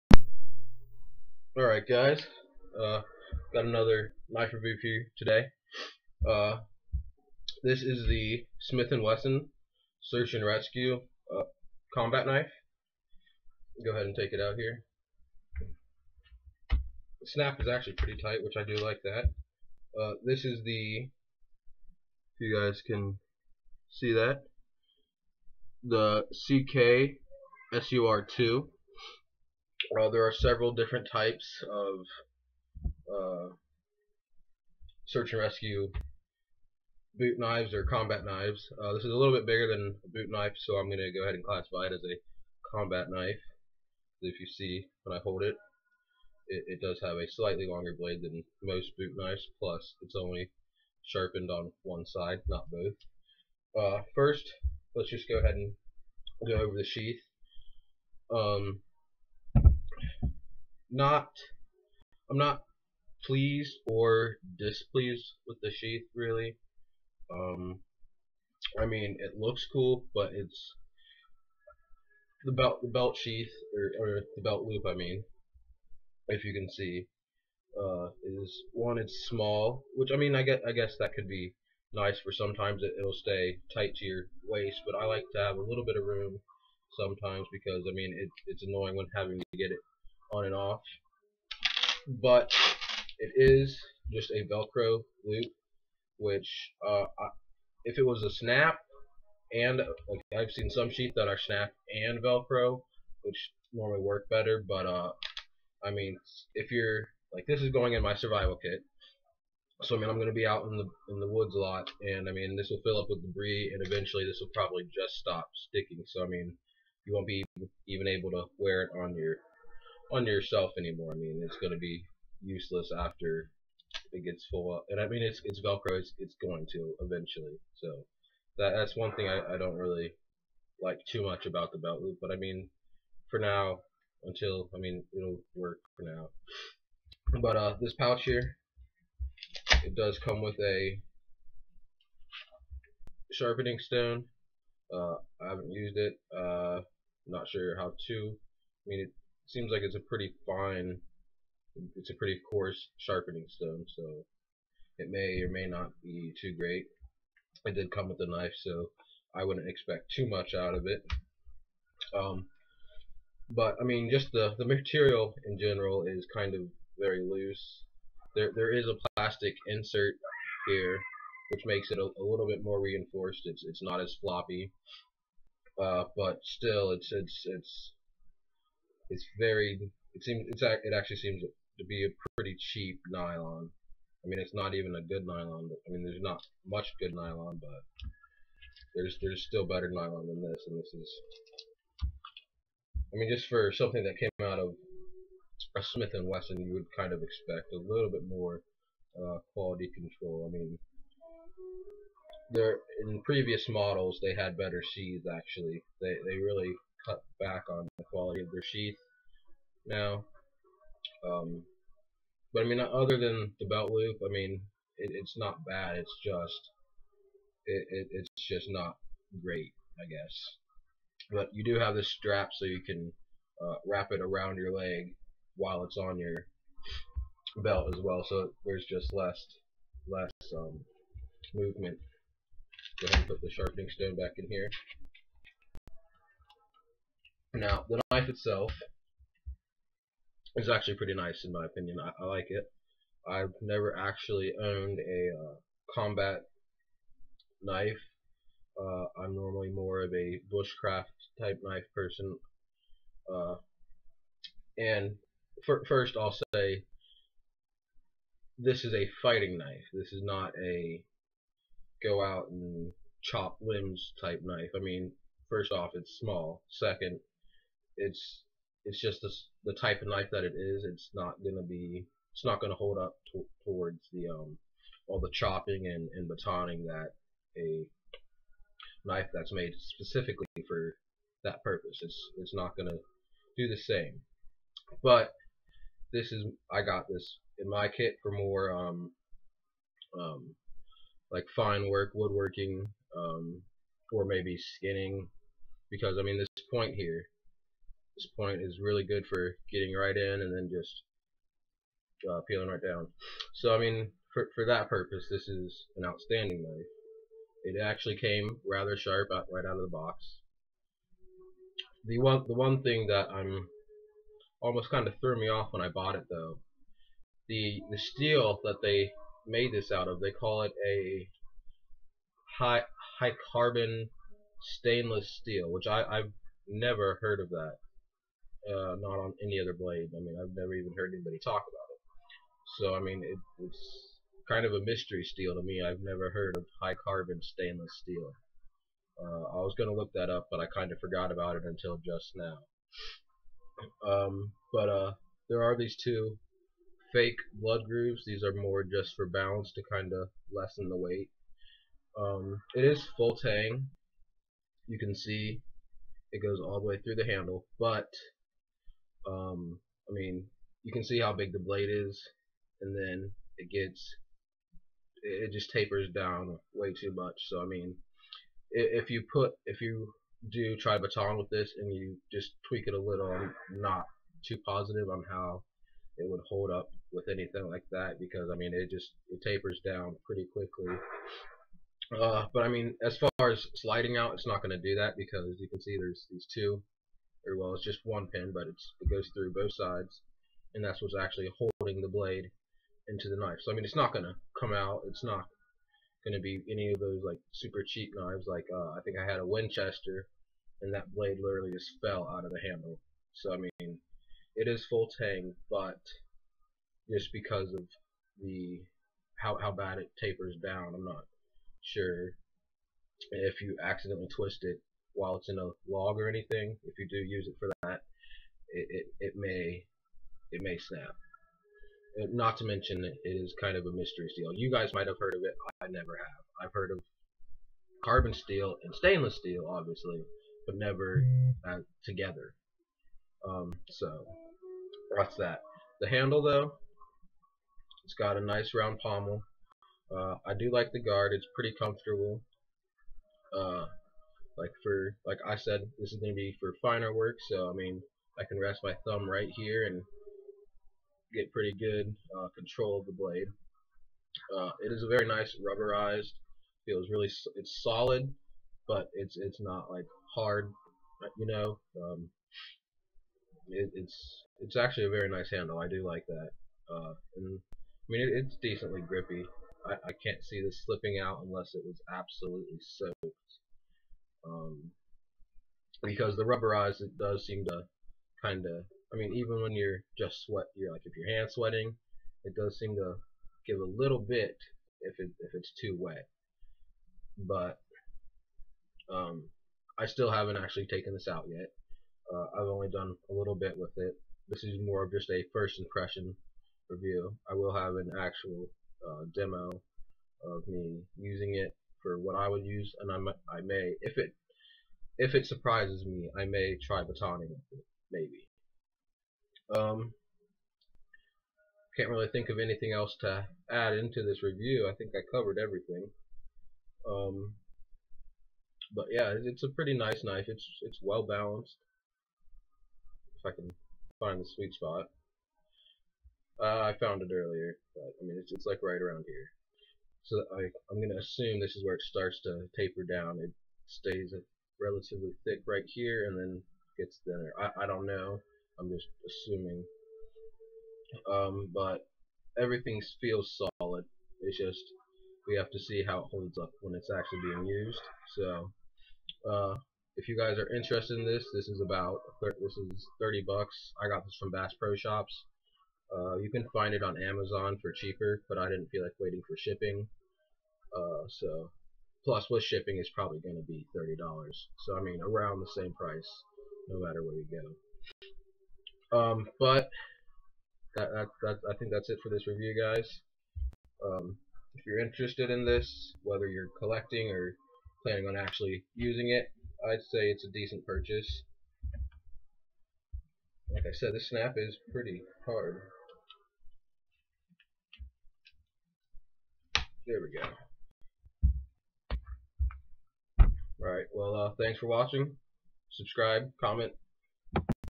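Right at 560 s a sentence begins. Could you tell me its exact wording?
Uh, so Plus, with shipping, is probably going to be $30.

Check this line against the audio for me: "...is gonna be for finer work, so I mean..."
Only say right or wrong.
right.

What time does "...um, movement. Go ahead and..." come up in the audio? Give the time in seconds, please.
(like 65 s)
230 s.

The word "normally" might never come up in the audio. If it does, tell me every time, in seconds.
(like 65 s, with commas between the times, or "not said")
103 s, 249 s.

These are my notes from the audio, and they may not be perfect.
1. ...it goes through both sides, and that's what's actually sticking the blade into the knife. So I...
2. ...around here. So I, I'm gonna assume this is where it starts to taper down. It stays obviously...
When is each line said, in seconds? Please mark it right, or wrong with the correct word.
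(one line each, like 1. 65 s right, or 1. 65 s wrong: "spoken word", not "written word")
1. 388 s wrong: "holding", not "sticking"
2. 529 s wrong: "relatively", not "obviously".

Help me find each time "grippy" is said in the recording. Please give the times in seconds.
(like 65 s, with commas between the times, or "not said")
469 s.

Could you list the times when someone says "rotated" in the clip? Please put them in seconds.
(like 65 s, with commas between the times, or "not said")
not said.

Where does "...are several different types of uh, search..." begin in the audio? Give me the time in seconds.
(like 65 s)
30 s.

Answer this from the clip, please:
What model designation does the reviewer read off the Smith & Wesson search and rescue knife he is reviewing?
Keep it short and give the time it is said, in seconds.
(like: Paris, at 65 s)
CK SUR2, at 26 s.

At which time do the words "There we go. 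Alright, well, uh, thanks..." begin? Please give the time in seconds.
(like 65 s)
590 s.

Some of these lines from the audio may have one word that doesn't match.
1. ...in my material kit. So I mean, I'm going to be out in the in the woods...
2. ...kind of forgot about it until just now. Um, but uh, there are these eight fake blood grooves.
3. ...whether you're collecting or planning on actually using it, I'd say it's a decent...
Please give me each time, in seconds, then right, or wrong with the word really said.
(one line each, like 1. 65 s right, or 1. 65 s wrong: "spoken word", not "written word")
1. 107 s wrong: "survival", not "material"
2. 340 s wrong: "two", not "eight"
3. 576 s right.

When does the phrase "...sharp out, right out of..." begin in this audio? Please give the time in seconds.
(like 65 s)
308 s.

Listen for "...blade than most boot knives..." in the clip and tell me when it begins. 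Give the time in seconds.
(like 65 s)
47 s.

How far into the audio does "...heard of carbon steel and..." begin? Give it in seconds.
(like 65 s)
426 s.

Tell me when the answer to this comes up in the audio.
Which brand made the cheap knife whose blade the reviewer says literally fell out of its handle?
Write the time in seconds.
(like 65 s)
399 s.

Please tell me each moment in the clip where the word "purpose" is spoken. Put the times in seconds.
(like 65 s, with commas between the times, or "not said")
281 s, 304 s.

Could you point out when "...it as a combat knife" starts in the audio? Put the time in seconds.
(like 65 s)
41 s.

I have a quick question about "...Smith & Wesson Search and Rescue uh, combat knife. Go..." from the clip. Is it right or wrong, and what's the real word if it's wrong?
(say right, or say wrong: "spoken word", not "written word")
right.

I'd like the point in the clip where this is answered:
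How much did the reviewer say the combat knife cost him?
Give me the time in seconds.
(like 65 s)
553 s.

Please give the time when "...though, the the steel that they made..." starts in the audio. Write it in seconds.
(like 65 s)
316 s.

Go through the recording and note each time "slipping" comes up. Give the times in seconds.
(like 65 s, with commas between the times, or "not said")
470 s.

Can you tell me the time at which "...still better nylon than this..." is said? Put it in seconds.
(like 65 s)
189 s.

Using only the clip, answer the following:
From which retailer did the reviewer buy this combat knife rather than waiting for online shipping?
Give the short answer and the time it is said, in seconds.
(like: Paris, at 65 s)
Bass Pro Shops, at 554 s.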